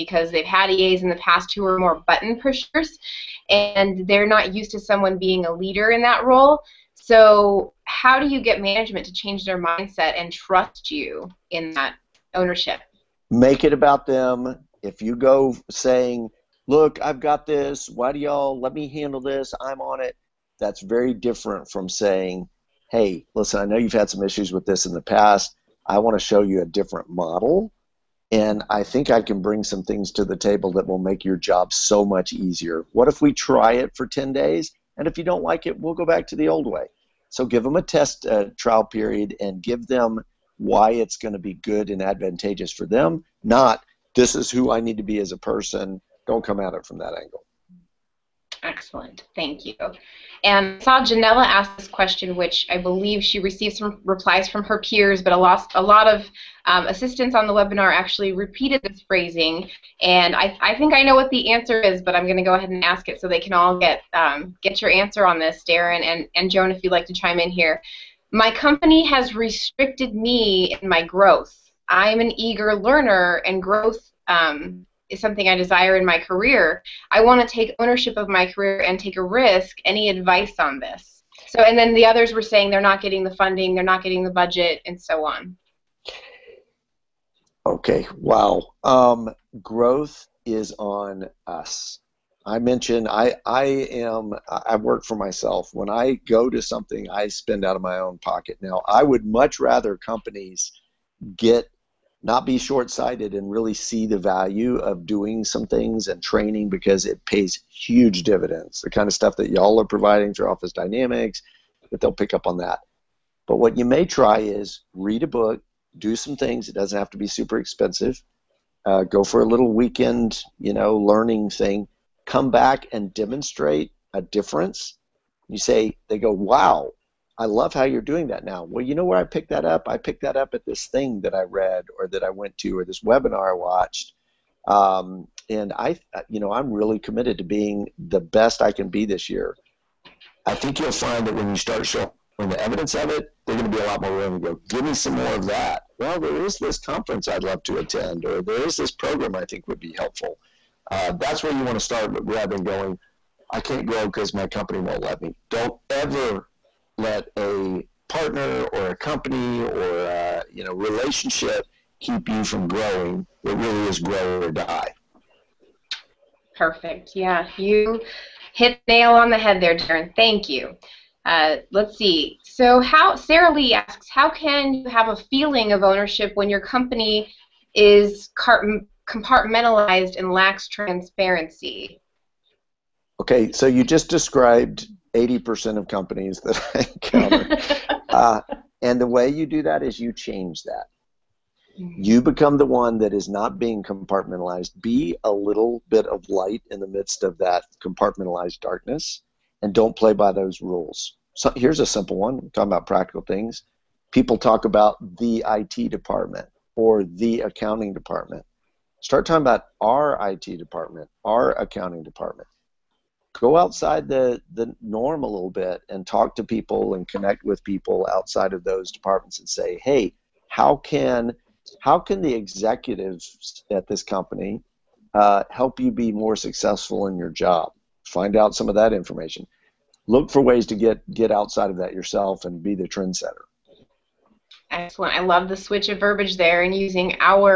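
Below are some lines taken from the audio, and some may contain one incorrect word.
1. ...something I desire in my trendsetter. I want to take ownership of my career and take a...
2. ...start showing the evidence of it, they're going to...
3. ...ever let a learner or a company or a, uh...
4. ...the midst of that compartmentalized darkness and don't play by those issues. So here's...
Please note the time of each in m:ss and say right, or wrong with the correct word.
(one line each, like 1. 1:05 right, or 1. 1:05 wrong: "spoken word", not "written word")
1. 1:15 wrong: "career", not "trendsetter"
2. 2:21 right
3. 2:35 wrong: "partner", not "learner"
4. 3:16 wrong: "rules", not "issues".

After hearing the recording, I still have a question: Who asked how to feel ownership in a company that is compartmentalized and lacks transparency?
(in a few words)
Sarah Lee.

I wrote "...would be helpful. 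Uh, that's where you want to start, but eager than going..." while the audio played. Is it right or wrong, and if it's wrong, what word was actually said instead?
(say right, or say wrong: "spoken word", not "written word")
wrong: "rather", not "eager".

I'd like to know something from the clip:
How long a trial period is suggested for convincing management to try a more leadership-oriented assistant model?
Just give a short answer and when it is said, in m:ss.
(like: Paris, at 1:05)
10 days, at 0:34.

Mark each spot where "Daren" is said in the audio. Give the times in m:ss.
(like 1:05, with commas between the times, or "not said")
1:05, 2:49.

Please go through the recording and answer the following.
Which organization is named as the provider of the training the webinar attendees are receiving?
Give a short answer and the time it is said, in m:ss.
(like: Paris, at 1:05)
Office Dynamics, at 1:50.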